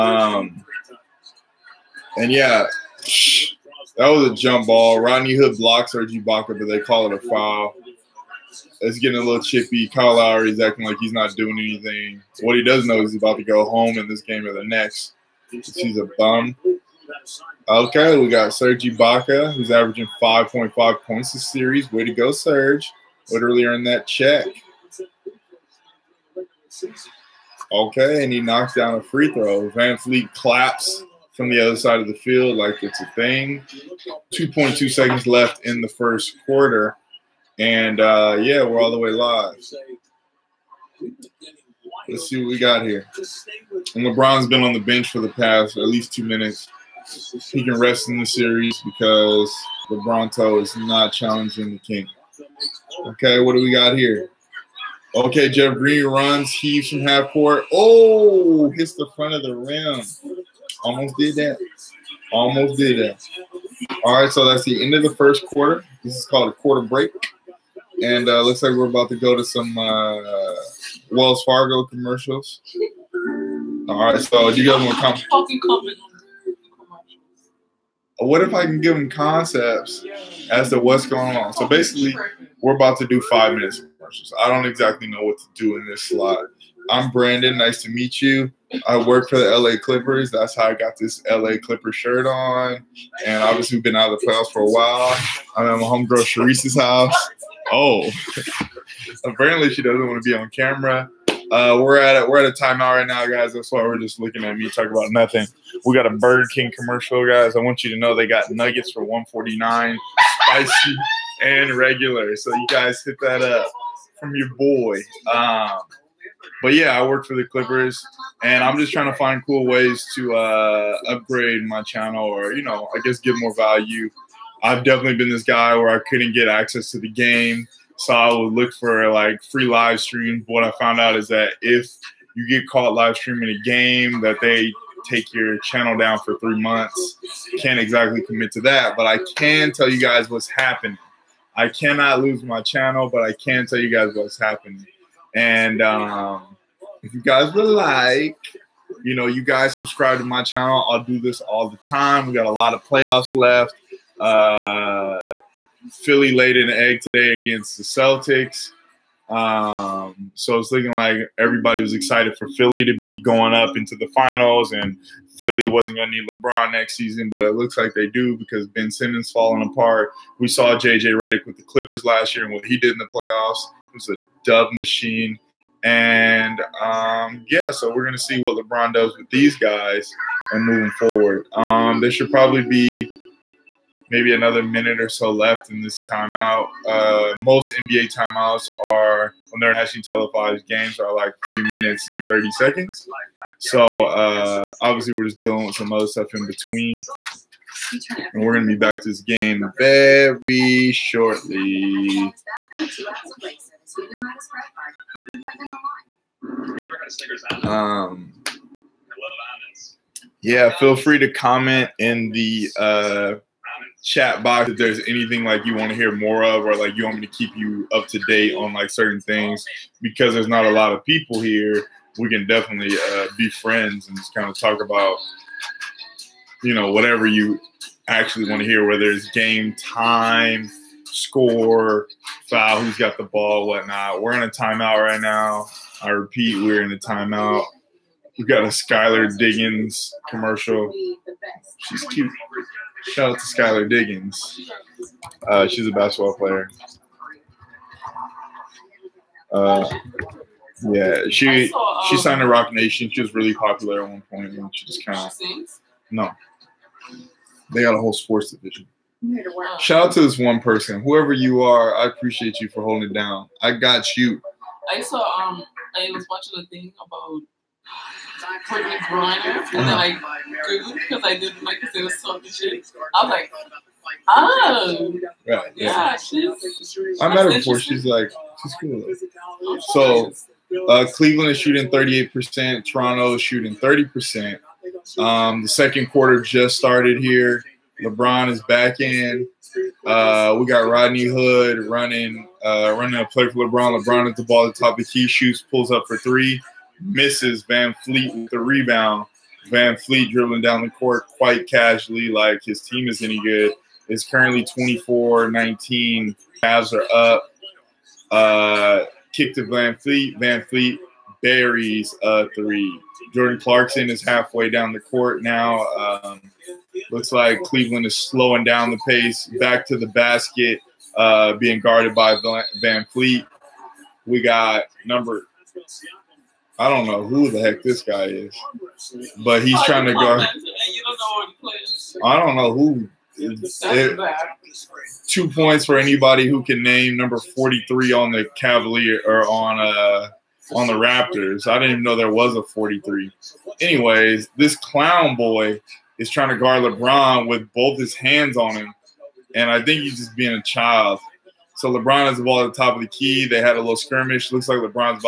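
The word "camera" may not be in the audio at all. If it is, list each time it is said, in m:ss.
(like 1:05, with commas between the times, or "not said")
1:40.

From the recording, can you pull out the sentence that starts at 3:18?
And we're going to be back to this game very shortly.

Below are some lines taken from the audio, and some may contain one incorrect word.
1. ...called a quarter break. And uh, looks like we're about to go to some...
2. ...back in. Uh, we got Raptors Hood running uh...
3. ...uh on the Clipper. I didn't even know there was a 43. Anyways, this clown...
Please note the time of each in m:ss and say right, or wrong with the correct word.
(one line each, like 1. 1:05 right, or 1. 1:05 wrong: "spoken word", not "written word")
1. 1:06 right
2. 4:48 wrong: "Rodney", not "Raptors"
3. 5:39 wrong: "Raptors", not "Clipper".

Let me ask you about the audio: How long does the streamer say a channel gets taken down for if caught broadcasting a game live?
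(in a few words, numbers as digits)
3 months.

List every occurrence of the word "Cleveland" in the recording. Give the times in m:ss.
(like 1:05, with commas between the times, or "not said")
4:41, 5:17.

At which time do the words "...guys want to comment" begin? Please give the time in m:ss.
1:14.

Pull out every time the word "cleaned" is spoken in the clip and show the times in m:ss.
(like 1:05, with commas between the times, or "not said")
not said.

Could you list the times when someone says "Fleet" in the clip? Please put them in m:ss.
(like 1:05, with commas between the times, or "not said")
5:10.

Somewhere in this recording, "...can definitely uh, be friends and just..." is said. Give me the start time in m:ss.
3:42.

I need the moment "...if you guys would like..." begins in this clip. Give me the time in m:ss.
2:27.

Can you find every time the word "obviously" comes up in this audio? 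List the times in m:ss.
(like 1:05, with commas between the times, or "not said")
1:33, 3:14.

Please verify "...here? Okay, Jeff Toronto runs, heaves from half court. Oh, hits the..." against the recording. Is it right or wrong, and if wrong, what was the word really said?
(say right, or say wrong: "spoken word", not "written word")
wrong: "Green", not "Toronto".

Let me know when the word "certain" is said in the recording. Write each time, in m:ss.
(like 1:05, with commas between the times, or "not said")
3:38.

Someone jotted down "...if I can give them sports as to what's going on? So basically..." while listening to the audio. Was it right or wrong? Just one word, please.
wrong.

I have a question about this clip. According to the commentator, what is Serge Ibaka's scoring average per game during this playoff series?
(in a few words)
5.5 points.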